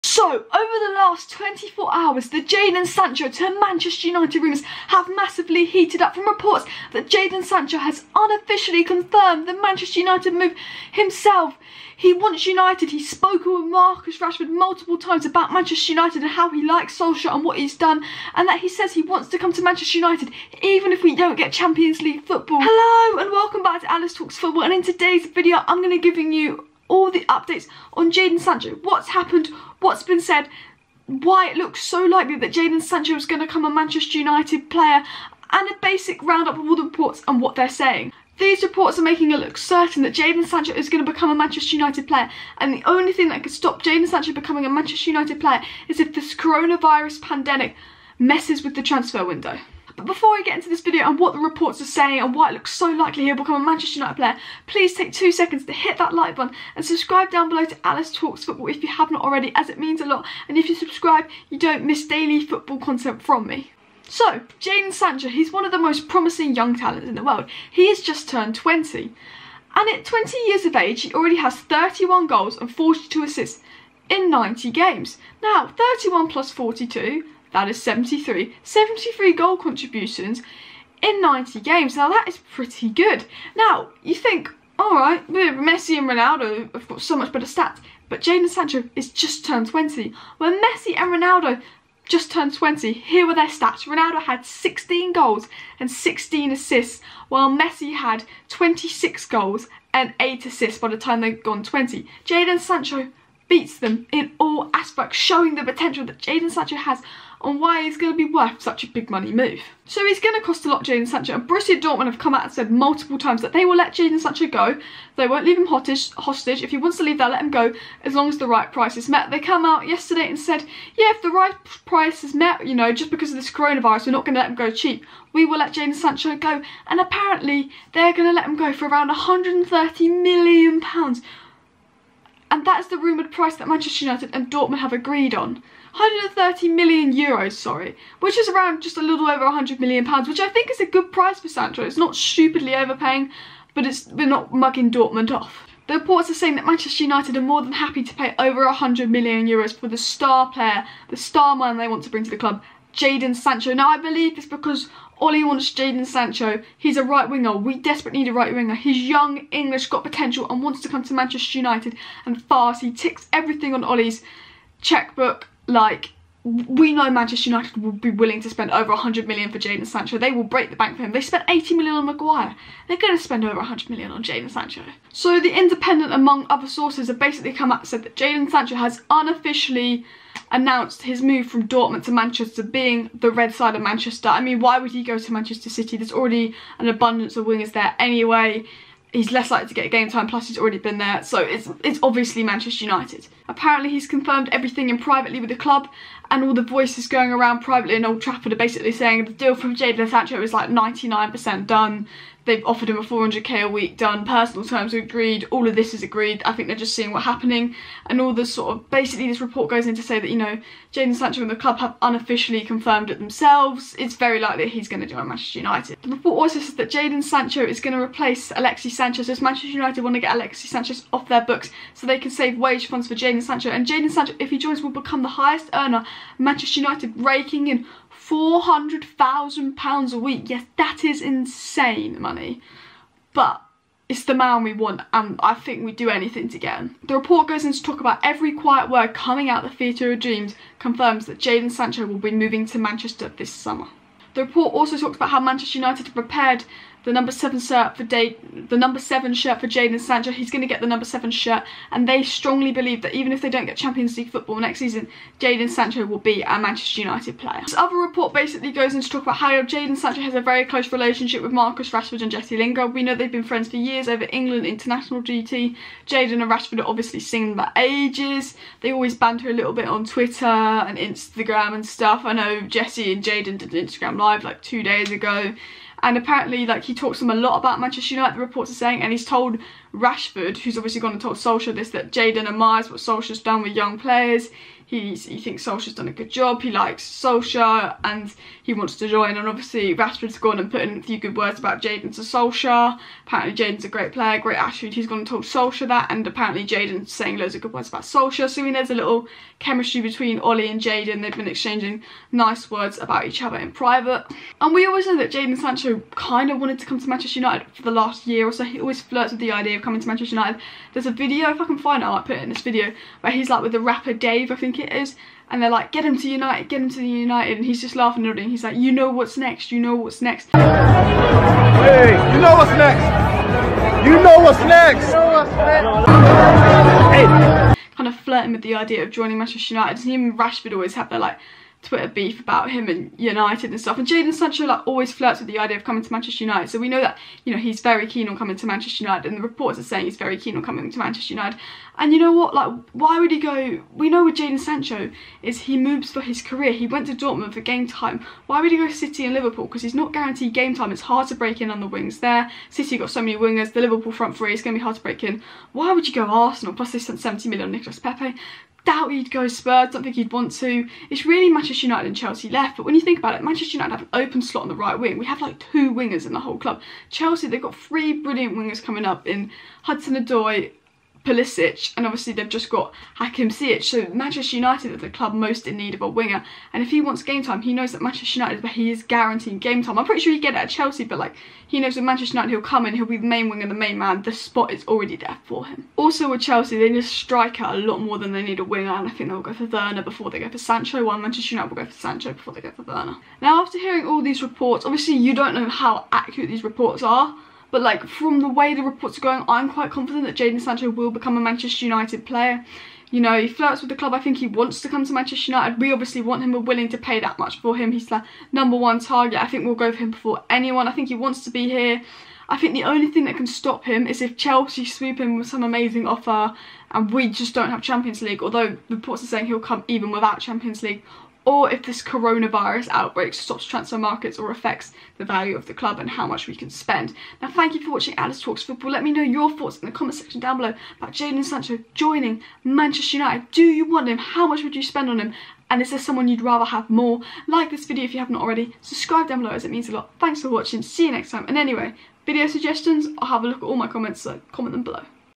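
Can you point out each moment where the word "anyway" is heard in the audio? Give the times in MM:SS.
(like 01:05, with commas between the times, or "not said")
03:07, 07:21.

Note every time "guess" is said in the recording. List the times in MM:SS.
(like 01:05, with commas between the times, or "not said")
not said.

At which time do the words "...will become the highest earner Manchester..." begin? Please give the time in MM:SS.
03:44.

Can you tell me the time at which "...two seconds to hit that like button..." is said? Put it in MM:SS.
00:55.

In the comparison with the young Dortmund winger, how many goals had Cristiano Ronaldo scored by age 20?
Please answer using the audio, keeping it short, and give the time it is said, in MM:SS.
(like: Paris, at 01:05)
16, at 01:33.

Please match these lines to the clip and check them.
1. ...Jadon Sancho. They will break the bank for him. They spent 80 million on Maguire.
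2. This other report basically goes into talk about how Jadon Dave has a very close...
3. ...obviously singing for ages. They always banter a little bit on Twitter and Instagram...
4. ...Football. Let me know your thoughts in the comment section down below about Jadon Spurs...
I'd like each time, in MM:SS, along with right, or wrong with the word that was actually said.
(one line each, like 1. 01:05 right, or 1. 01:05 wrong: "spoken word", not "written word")
1. 02:49 right
2. 04:17 wrong: "Sancho", not "Dave"
3. 04:26 right
4. 07:08 wrong: "Sancho", not "Spurs".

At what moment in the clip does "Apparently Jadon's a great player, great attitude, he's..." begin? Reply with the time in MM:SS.
04:53.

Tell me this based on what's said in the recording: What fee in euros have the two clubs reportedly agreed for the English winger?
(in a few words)
130 million euros.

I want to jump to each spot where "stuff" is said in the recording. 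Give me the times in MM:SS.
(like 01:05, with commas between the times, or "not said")
04:31, 05:33.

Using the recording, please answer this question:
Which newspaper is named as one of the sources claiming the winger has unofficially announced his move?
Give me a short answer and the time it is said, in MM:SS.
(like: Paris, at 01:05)
The Independent, at 02:55.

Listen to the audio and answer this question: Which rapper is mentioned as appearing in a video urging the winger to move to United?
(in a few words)
Dave.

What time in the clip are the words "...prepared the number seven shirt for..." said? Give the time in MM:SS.
04:06.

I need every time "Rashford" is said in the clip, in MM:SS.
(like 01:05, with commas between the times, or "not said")
00:14, 04:21, 04:26, 04:39, 04:49, 05:30.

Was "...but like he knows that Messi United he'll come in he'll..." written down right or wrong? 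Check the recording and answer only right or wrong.
wrong.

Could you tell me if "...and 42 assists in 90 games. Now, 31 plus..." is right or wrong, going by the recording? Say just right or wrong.
right.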